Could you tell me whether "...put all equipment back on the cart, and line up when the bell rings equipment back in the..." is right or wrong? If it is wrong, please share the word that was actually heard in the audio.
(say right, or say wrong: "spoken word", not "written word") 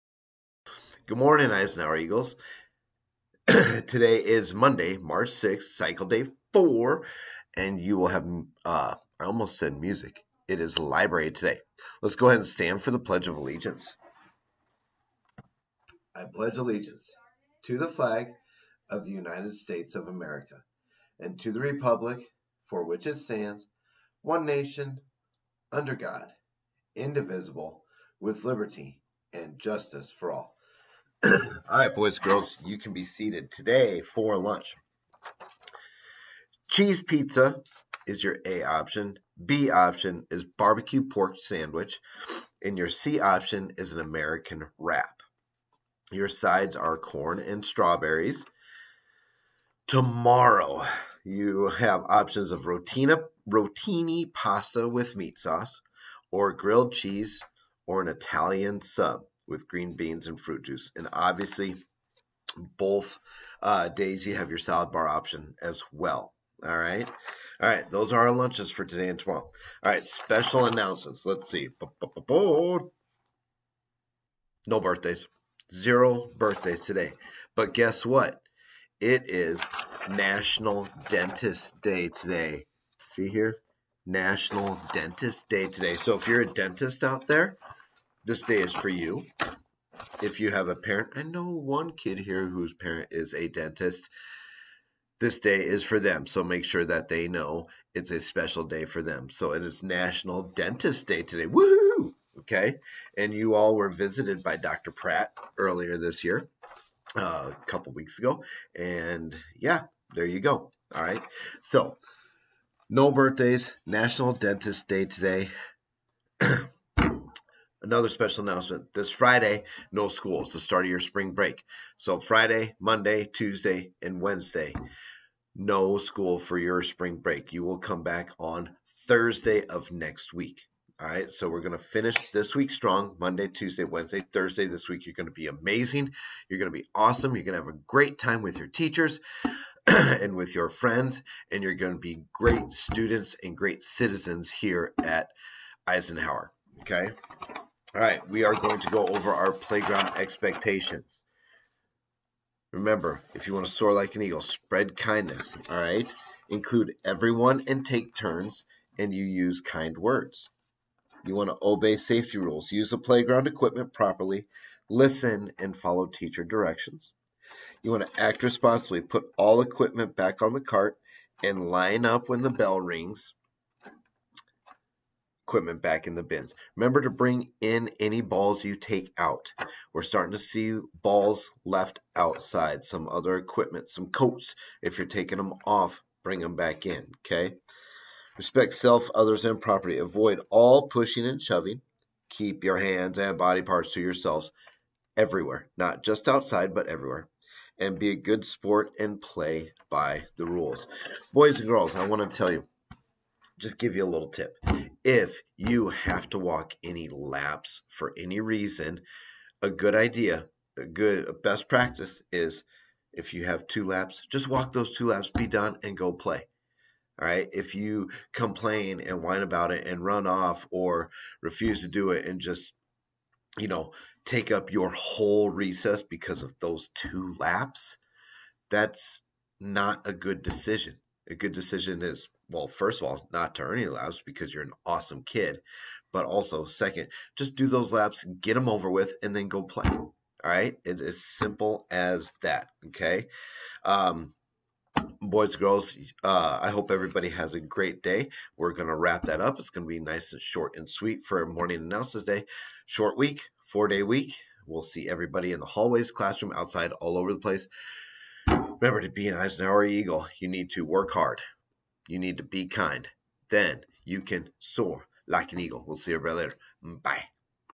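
right.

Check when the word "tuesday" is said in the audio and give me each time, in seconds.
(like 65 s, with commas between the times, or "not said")
123 s, 133 s.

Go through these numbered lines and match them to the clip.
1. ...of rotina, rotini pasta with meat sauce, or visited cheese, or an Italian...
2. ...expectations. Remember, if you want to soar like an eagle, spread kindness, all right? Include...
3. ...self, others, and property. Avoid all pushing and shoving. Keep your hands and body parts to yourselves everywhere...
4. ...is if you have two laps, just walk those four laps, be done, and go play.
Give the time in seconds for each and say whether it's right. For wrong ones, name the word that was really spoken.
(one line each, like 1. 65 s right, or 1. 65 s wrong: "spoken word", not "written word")
1. 52 s wrong: "grilled", not "visited"
2. 150 s right
3. 188 s right
4. 212 s wrong: "two", not "four".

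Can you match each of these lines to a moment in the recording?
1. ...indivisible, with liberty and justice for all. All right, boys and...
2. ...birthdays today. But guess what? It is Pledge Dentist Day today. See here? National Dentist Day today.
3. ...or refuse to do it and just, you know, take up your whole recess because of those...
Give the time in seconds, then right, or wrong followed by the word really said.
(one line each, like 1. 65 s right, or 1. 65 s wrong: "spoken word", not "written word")
1. 26 s right
2. 76 s wrong: "National", not "Pledge"
3. 220 s right.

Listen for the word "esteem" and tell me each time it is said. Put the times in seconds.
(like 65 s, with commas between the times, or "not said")
not said.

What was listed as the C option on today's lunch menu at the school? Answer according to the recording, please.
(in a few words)
American wrap.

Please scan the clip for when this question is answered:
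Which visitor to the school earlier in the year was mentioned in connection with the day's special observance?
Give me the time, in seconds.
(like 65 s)
104 s.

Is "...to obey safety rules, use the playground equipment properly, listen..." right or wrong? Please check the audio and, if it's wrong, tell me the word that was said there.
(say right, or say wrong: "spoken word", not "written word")
right.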